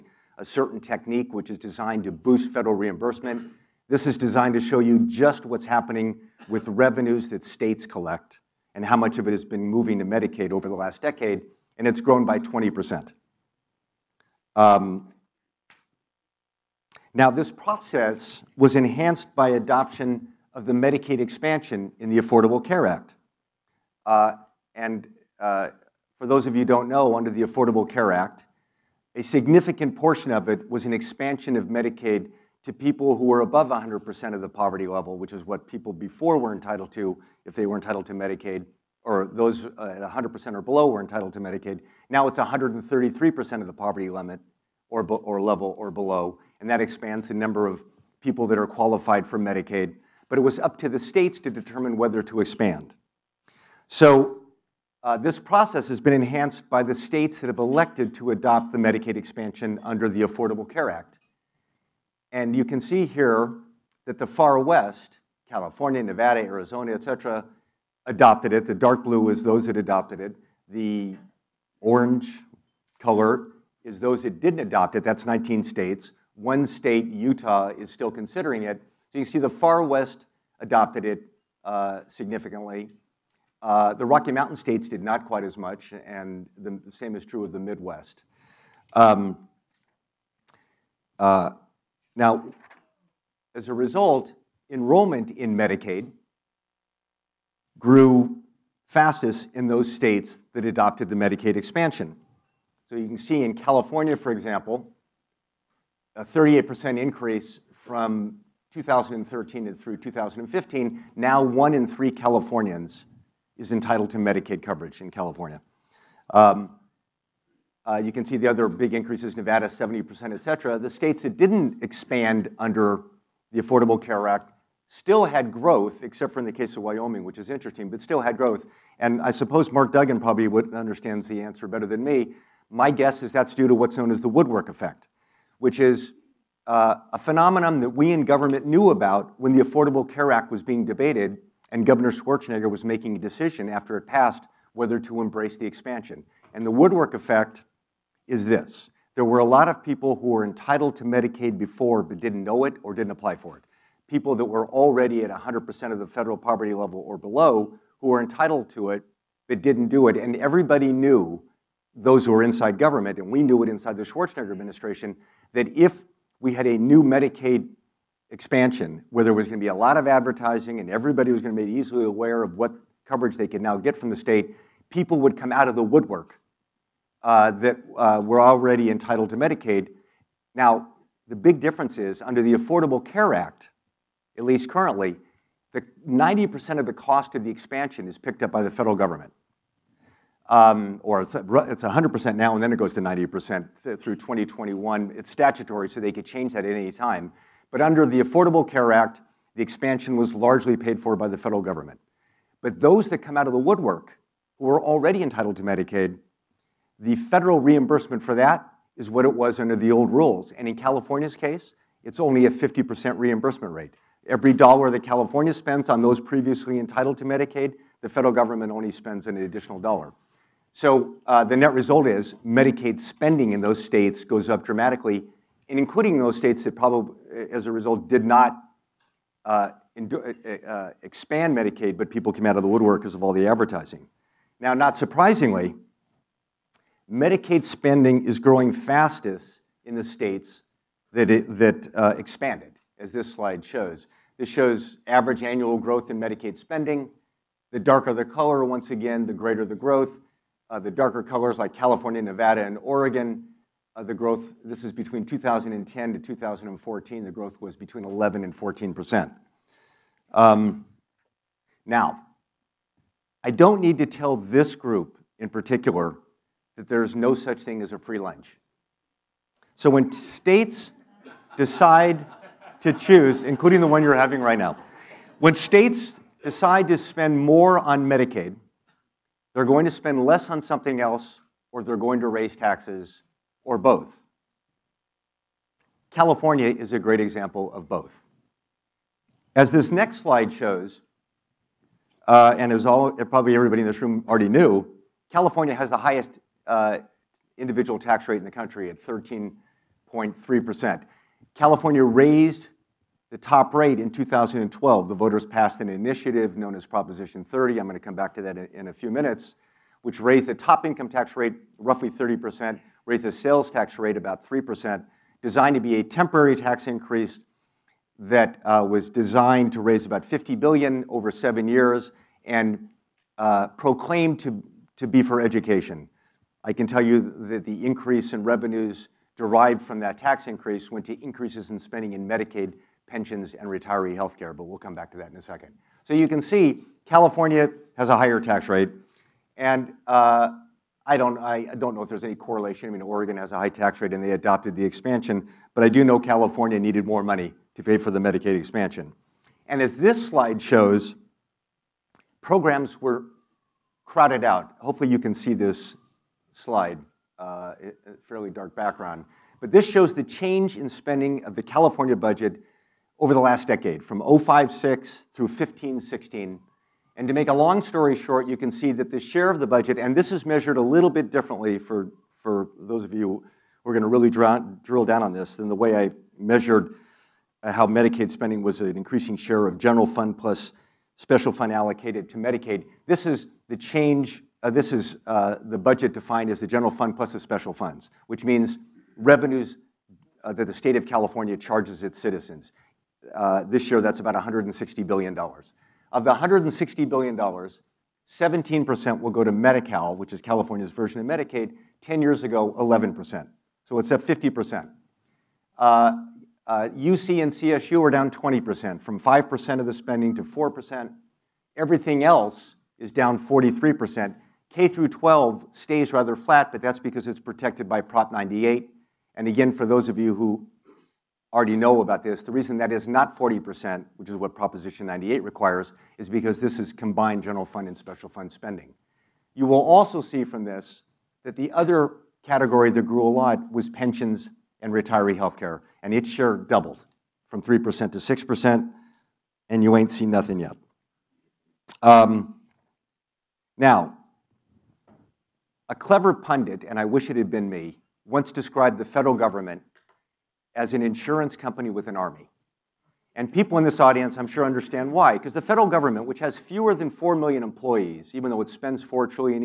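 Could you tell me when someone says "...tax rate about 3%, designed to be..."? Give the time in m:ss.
5:13.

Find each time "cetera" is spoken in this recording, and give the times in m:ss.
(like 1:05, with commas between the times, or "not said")
1:07, 2:00.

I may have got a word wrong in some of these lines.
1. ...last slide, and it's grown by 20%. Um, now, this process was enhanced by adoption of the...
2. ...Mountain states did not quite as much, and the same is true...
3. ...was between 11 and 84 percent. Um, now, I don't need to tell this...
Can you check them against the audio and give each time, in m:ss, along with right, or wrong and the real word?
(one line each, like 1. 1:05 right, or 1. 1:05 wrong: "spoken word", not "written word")
1. 0:10 wrong: "decade", not "slide"
2. 1:24 right
3. 4:17 wrong: "14", not "84".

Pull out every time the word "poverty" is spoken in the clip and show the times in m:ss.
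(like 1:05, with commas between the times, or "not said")
0:34, 0:43, 2:36.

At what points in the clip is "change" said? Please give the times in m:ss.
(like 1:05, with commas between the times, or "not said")
3:16, 6:00, 6:23.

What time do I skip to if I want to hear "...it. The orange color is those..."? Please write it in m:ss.
1:10.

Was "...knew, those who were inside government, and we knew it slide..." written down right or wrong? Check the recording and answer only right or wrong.
wrong.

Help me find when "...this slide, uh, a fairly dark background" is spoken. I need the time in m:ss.
5:55.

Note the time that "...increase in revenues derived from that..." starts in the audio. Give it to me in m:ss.
5:27.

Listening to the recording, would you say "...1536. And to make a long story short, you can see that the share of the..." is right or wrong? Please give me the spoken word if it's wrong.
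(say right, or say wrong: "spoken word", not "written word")
wrong: "1516", not "1536".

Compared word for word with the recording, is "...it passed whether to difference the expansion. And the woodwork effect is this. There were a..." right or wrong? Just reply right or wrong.
wrong.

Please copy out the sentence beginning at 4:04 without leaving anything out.
This shows average annual growth in Medicaid spending.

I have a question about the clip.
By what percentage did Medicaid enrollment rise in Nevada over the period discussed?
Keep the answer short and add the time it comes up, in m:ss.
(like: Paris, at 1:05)
70%, at 1:59.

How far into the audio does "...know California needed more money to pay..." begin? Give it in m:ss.
5:46.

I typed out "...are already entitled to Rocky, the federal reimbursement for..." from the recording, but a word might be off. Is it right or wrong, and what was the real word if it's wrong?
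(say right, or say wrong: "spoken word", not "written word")
wrong: "Medicaid", not "Rocky".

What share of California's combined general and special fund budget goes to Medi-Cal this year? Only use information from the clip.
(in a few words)
17%.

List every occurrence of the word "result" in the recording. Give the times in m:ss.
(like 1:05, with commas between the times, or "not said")
1:33, 3:41, 3:47.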